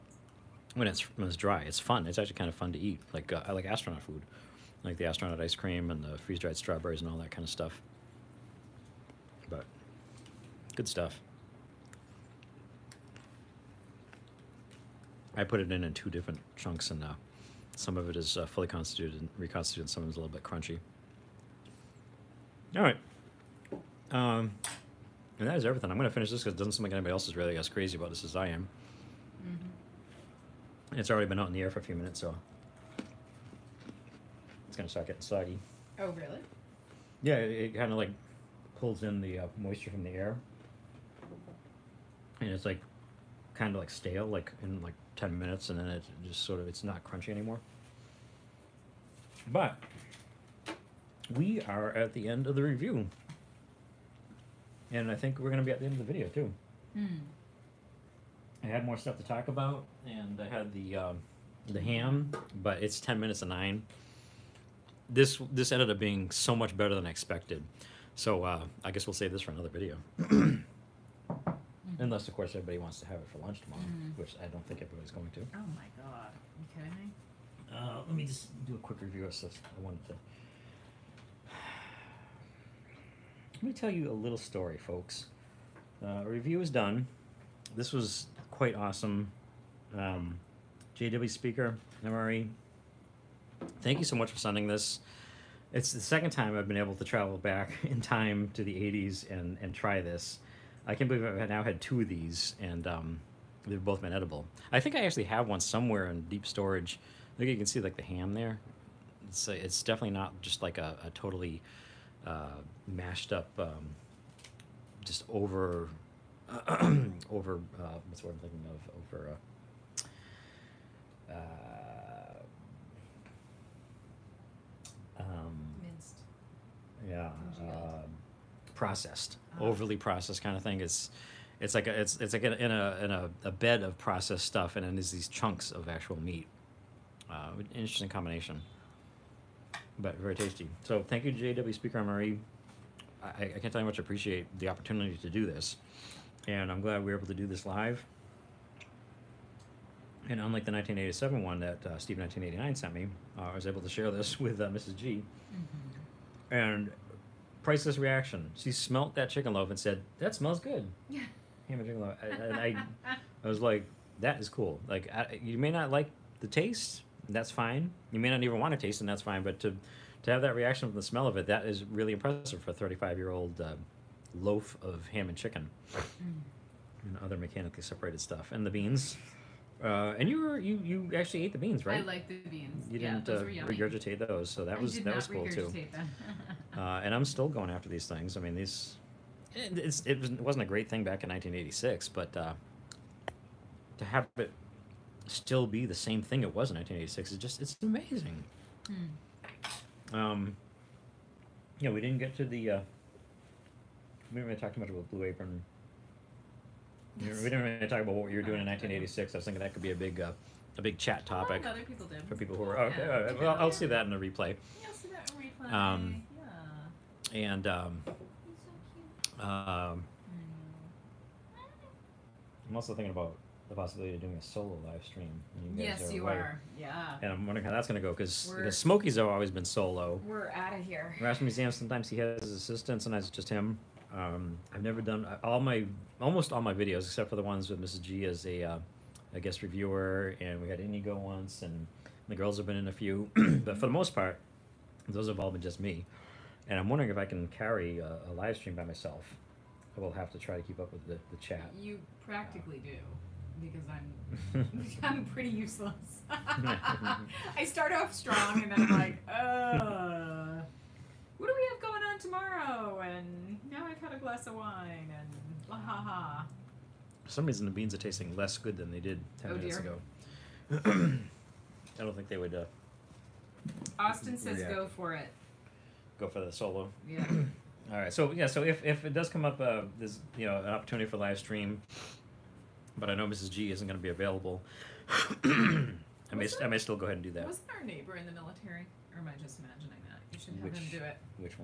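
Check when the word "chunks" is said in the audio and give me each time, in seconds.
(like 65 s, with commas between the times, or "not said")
16 s, 135 s.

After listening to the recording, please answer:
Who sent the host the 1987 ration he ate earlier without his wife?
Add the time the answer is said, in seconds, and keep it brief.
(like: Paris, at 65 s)
Steve 1989, at 151 s.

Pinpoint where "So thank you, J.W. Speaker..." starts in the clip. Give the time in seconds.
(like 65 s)
140 s.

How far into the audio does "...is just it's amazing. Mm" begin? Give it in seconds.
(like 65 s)
197 s.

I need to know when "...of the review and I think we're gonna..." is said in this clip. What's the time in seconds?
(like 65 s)
52 s.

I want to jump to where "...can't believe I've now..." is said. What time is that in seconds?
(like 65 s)
100 s.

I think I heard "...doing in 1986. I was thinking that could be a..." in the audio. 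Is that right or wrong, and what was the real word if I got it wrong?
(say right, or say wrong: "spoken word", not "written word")
right.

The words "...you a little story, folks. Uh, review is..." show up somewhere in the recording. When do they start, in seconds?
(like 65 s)
83 s.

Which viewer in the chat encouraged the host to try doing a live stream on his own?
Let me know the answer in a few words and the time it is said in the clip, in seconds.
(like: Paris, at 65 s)
Austin, at 273 s.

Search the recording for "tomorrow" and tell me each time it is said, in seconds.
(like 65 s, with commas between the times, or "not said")
73 s, 262 s.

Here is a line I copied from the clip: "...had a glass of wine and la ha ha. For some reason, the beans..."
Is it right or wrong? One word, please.
right.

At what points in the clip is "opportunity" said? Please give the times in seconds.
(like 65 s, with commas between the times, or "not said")
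144 s, 280 s.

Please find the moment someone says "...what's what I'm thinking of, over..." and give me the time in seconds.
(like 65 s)
118 s.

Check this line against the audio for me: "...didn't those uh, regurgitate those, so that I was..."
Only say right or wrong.
right.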